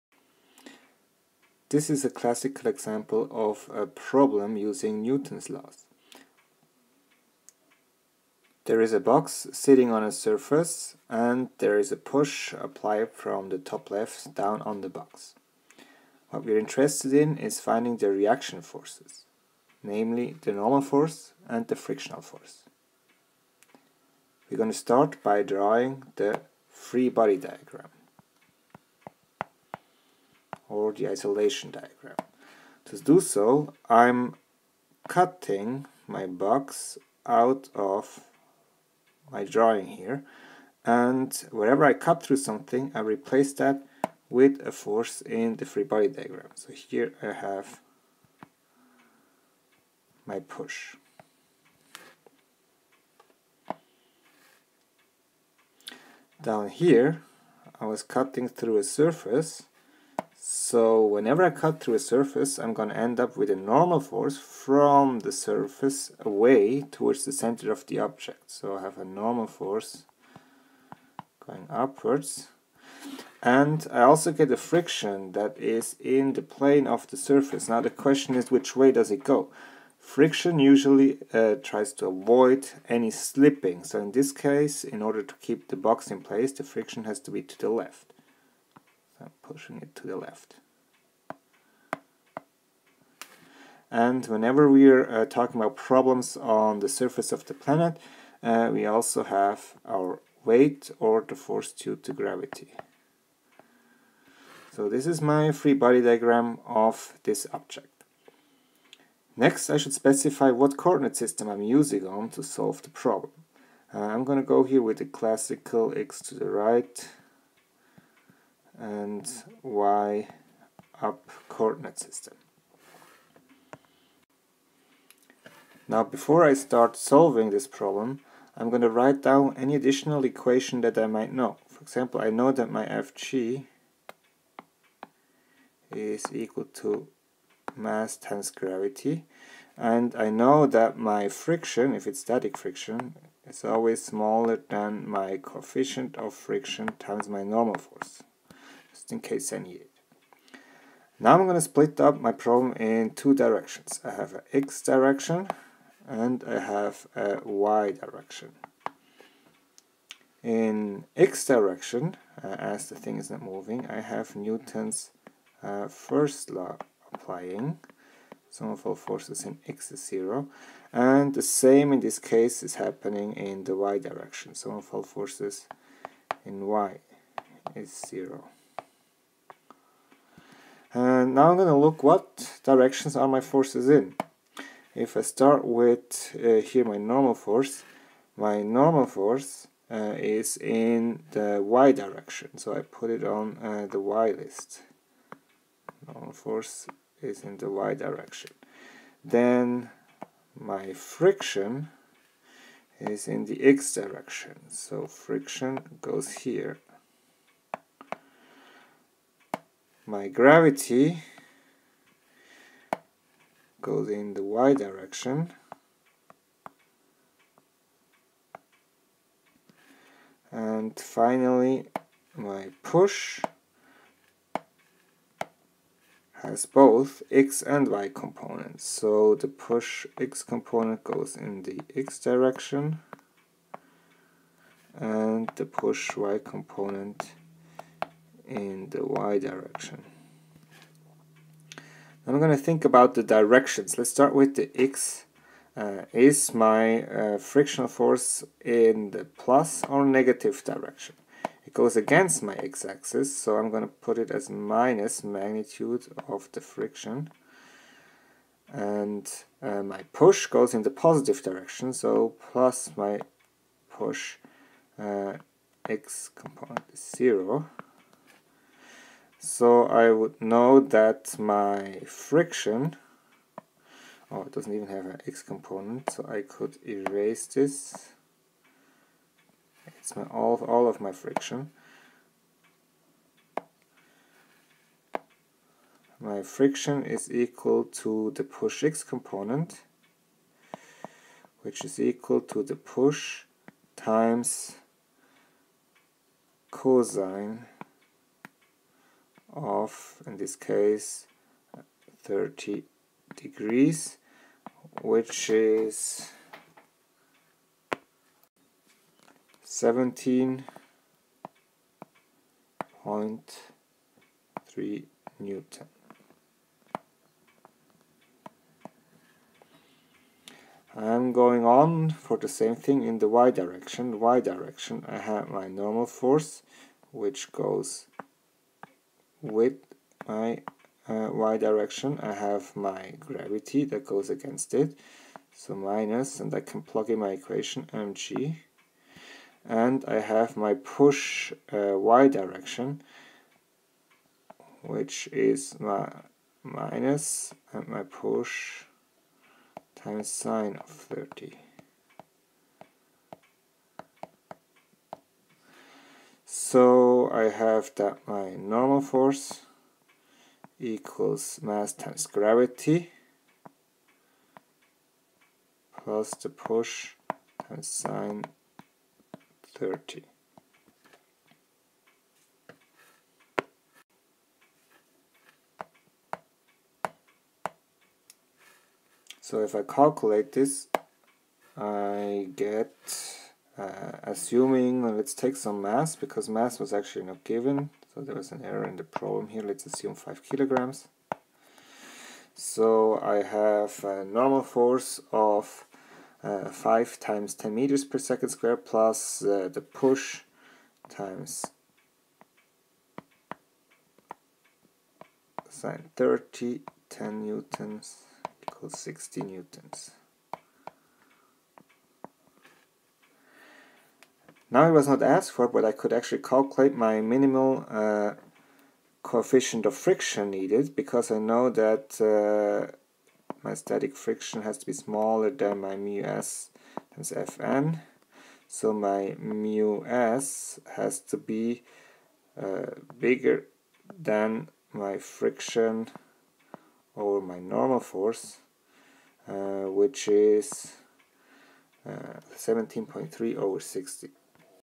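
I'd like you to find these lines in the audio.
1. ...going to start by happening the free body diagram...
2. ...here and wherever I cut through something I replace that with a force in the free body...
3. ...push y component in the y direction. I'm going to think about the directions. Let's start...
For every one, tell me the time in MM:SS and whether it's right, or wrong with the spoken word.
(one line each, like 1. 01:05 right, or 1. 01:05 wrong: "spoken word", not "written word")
1. 00:24 wrong: "drawing", not "happening"
2. 00:39 right
3. 03:55 right.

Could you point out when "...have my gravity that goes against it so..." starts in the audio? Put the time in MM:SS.
05:32.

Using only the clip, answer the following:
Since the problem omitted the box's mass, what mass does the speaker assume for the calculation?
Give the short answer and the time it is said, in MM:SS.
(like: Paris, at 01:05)
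5 kg, at 06:30.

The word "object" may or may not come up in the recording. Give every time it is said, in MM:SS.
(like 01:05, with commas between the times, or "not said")
01:07, 01:47.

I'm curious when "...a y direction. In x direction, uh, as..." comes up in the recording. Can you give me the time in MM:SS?
02:37.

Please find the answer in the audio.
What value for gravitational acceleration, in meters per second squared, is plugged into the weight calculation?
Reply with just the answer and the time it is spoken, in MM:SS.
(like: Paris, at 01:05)
10, at 06:37.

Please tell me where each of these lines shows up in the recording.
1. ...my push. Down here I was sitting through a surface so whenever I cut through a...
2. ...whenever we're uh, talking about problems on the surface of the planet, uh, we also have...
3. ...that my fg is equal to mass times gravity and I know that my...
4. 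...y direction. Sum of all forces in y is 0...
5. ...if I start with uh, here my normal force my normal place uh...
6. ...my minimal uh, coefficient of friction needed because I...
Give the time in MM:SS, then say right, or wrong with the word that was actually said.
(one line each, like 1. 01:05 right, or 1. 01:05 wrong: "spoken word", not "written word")
1. 00:50 wrong: "cutting", not "sitting"
2. 01:34 right
3. 02:12 right
4. 02:53 right
5. 03:04 wrong: "force", not "place"
6. 06:56 right.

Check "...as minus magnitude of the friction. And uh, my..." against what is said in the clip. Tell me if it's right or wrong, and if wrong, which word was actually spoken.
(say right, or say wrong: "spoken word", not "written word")
right.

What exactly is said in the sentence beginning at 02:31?
Now I'm going to split up my problem in two directions.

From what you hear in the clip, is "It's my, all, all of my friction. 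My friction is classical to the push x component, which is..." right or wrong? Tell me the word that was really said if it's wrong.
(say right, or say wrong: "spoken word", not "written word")
wrong: "equal", not "classical".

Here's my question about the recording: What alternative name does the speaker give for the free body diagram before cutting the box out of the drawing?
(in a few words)
isolation diagram.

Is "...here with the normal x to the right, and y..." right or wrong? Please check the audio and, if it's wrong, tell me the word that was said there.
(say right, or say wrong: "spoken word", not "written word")
wrong: "classical", not "normal".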